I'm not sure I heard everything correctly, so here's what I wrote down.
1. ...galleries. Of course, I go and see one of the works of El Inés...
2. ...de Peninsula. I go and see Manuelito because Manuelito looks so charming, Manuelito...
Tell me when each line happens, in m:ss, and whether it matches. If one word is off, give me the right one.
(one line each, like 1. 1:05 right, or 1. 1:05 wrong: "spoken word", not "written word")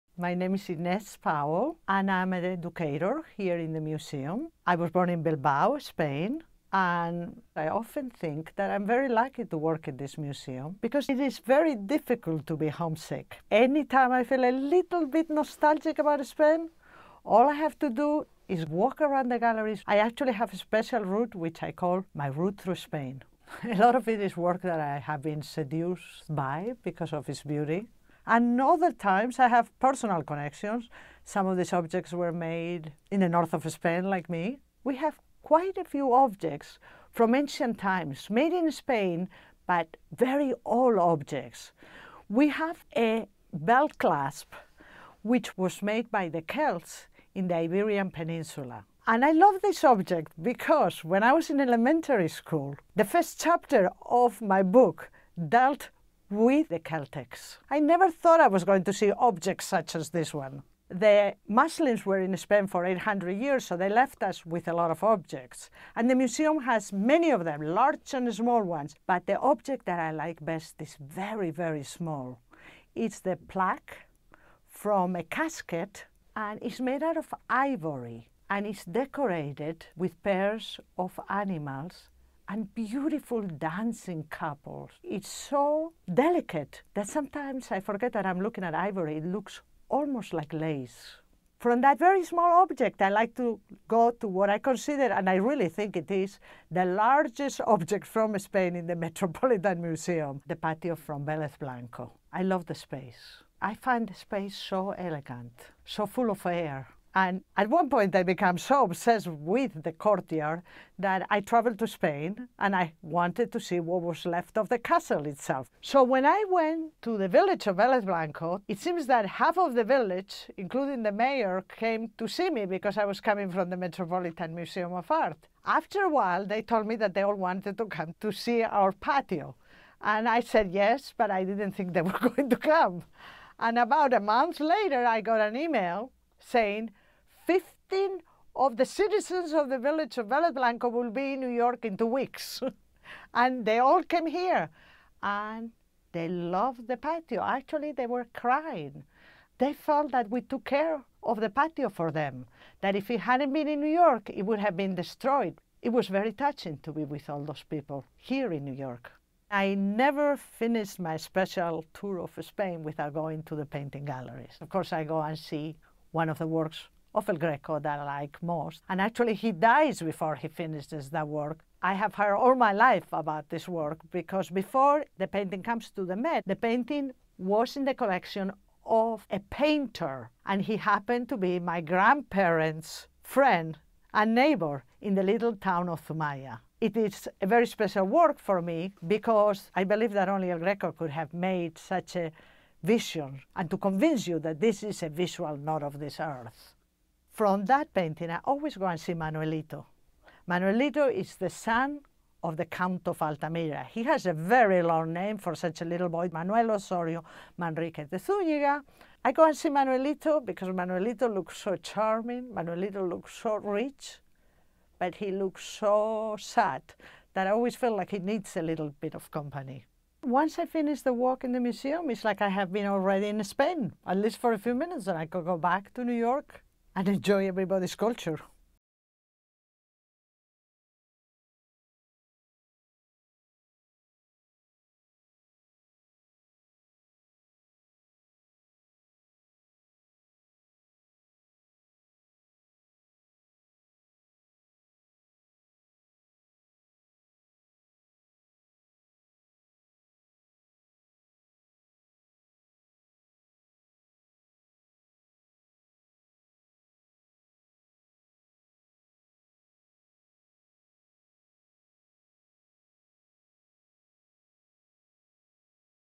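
1. 2:44 wrong: "Greco", not "Inés"
2. 3:28 wrong: "Zúñiga", not "Peninsula".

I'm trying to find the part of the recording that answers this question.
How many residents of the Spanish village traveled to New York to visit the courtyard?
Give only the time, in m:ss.
2:17.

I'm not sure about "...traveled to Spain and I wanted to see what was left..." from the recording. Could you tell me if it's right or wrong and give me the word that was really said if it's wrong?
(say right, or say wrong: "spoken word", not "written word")
right.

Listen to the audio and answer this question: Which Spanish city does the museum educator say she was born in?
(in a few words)
Bilbao.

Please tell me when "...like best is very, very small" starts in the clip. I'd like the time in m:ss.
1:10.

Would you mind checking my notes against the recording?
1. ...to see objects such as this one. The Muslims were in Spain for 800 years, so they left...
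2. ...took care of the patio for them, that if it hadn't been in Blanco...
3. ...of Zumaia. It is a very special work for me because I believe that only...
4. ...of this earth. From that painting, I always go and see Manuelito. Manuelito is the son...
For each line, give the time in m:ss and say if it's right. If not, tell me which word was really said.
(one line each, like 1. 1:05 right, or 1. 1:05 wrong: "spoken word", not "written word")
1. 0:58 right
2. 2:30 wrong: "New", not "Blanco"
3. 3:05 right
4. 3:15 right.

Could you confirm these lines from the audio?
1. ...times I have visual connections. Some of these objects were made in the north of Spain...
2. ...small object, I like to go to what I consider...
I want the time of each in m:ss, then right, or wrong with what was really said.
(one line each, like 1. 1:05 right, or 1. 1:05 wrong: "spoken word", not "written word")
1. 0:28 wrong: "personal", not "visual"
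2. 1:32 right.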